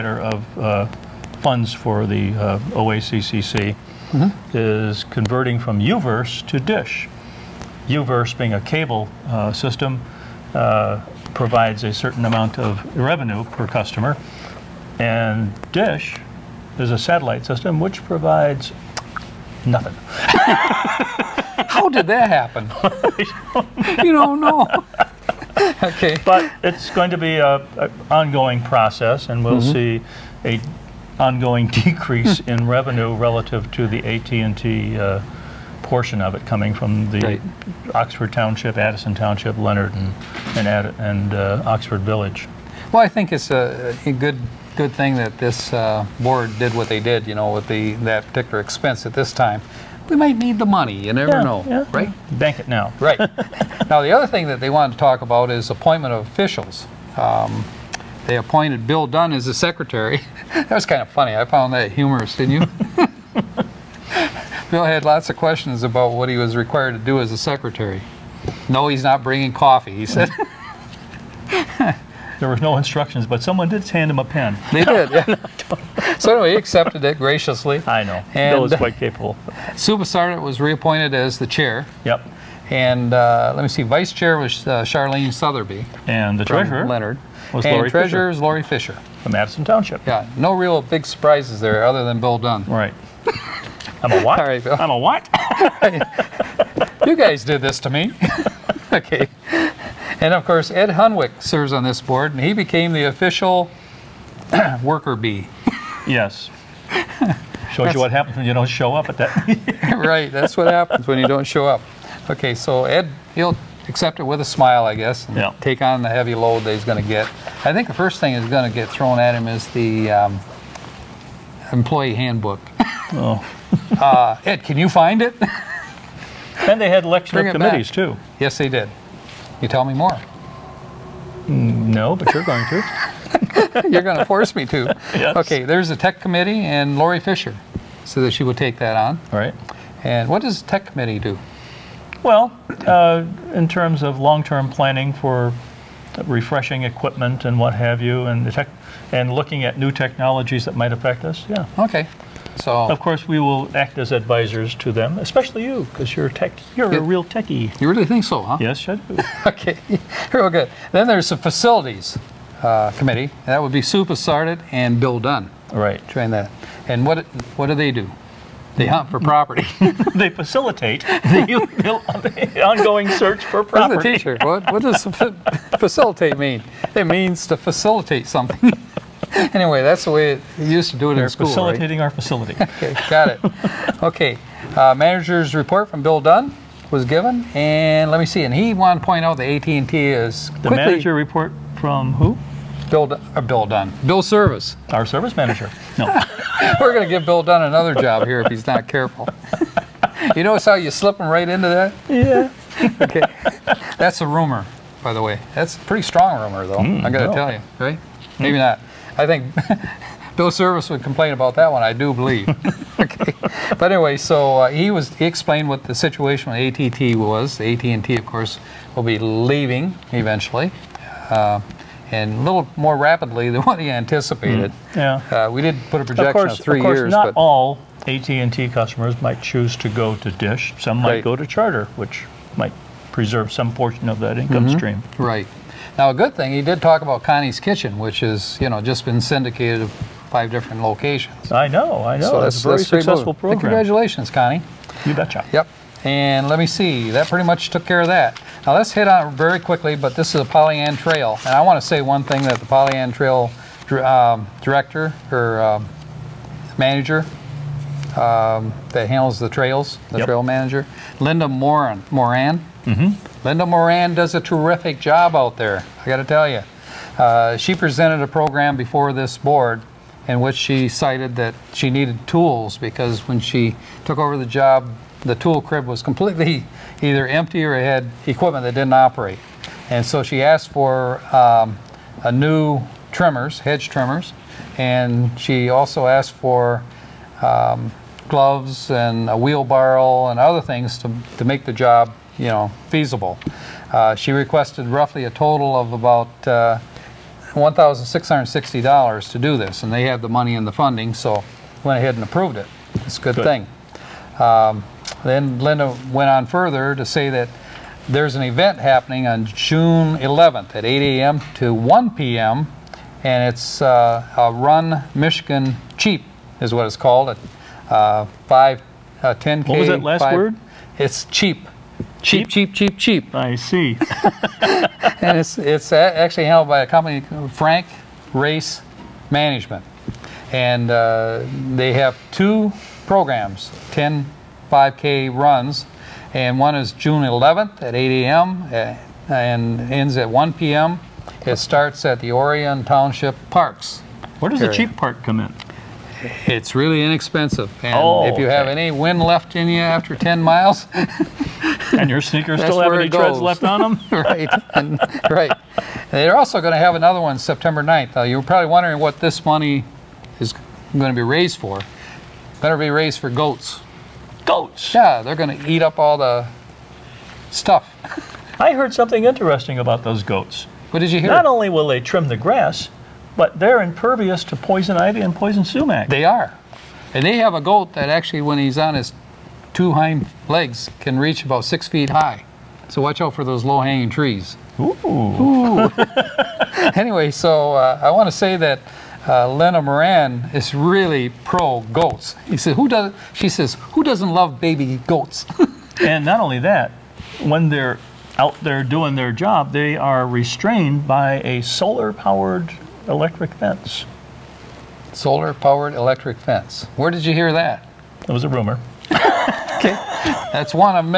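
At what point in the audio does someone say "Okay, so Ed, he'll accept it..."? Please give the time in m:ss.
1:52.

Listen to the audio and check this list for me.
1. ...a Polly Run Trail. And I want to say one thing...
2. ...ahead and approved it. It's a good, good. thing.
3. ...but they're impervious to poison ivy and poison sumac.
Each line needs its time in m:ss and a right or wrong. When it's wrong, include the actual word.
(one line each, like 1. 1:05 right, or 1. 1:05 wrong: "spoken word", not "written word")
1. 4:10 wrong: "Ann", not "Run"
2. 5:01 right
3. 6:13 right.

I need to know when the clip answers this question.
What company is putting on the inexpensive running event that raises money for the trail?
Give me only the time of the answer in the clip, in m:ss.
5:27.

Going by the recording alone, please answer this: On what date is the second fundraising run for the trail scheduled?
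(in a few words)
September 9.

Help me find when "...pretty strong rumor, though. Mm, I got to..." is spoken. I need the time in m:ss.
3:25.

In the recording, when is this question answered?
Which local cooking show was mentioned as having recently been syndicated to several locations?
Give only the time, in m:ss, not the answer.
3:57.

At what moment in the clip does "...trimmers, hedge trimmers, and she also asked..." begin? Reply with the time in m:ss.
4:43.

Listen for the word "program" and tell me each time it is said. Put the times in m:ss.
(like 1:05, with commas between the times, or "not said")
4:03, 4:28, 5:33.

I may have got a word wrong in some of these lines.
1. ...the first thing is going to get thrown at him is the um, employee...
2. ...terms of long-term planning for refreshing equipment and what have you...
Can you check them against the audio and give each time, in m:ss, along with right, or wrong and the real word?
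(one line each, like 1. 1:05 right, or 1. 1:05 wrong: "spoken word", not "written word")
1. 1:57 right
2. 2:23 right.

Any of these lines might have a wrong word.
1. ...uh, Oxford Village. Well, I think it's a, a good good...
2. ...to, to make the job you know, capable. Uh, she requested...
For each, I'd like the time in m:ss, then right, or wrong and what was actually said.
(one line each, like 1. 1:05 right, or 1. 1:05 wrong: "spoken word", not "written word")
1. 0:41 right
2. 4:50 wrong: "feasible", not "capable".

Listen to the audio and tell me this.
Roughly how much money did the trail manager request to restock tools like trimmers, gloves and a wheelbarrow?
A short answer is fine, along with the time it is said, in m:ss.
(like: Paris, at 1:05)
$1,660, at 4:57.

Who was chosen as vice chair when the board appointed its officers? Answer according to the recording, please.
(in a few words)
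Charlene Sotheby.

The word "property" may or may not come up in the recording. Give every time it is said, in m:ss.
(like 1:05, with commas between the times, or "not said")
2:49, 2:53.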